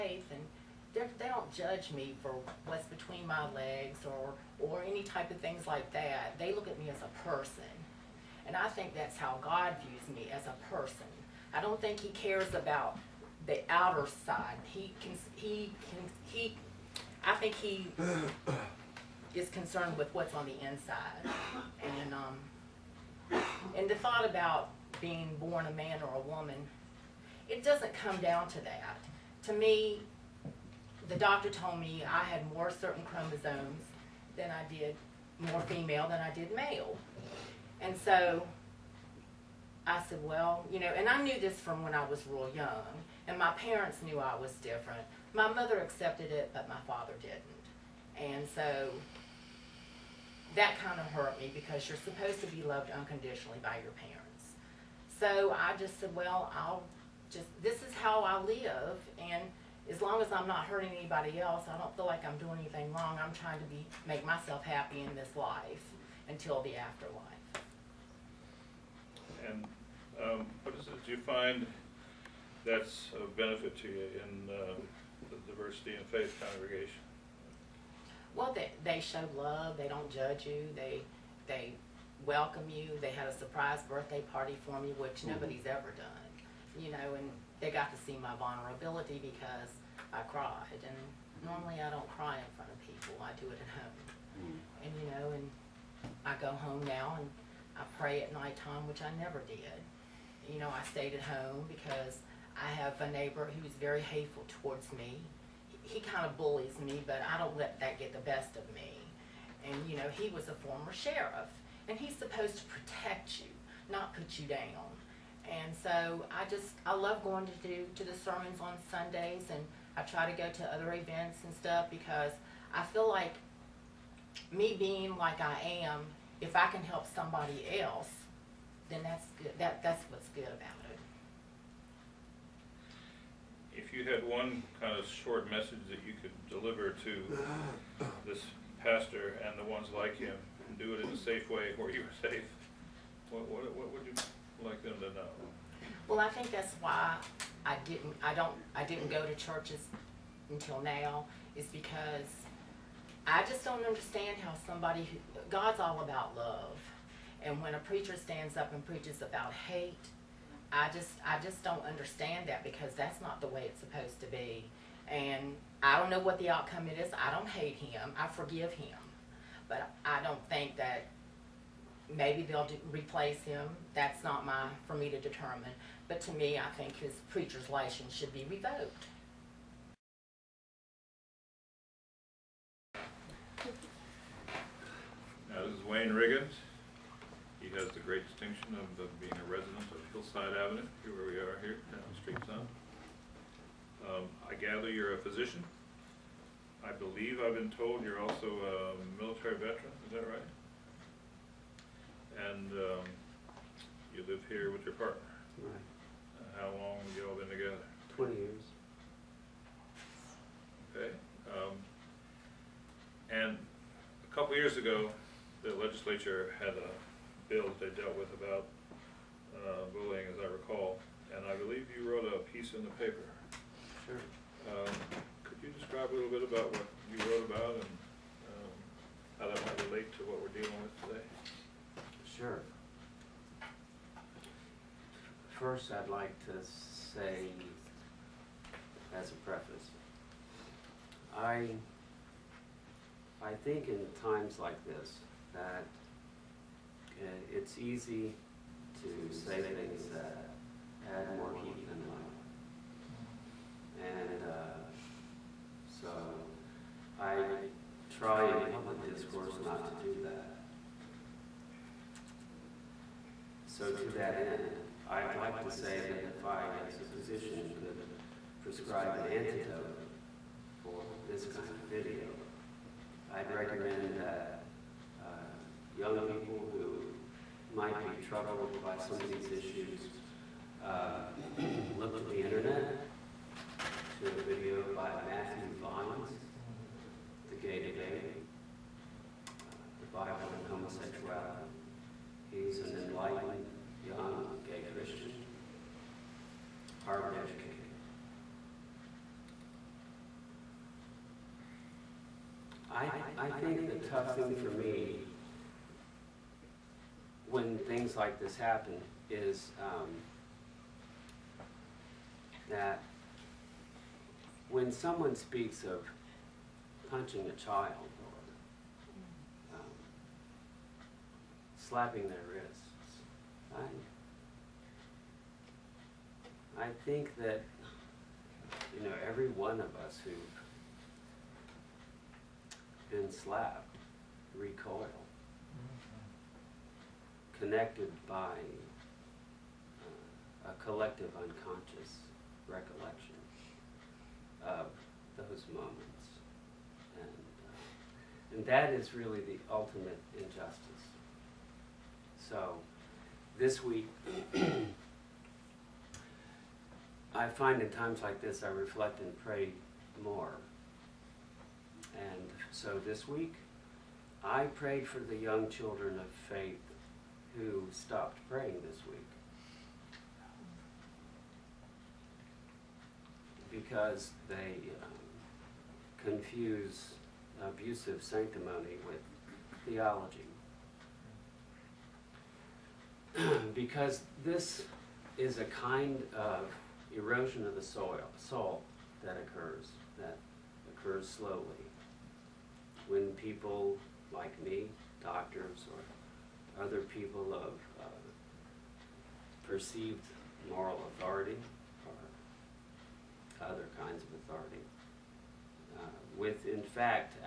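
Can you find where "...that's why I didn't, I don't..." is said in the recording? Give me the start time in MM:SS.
02:26.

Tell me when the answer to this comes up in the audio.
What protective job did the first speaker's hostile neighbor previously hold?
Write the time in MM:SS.
01:50.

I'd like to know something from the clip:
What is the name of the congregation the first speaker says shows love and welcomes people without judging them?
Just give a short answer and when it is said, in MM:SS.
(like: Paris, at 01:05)
Diversity in Faith, at 01:15.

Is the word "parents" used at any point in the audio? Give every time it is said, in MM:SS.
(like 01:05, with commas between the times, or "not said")
00:43, 00:53.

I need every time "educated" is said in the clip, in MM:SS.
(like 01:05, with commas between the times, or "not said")
04:57.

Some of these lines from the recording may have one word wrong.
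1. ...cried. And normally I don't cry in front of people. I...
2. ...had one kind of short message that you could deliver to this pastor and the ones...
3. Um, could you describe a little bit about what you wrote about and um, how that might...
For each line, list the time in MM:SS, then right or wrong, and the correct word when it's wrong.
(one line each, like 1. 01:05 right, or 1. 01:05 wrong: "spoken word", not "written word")
1. 01:30 right
2. 02:14 right
3. 03:44 right.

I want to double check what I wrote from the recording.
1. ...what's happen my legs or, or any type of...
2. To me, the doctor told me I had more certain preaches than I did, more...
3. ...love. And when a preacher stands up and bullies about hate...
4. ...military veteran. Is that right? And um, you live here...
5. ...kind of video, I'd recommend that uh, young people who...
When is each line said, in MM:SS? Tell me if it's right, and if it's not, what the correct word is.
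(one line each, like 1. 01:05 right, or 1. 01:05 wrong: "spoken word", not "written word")
1. 00:02 wrong: "between", not "happen"
2. 00:29 wrong: "chromosomes", not "preaches"
3. 02:36 wrong: "preaches", not "bullies"
4. 03:19 right
5. 04:31 right.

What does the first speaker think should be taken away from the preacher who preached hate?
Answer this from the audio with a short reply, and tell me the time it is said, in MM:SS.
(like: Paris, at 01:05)
Preacher's license, at 02:57.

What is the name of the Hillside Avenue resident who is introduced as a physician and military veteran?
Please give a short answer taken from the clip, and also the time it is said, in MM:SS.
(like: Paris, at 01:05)
Wayne Riggins, at 03:05.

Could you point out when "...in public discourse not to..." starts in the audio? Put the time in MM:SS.
04:18.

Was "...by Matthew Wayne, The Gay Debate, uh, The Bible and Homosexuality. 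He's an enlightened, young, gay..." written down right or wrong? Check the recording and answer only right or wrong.
wrong.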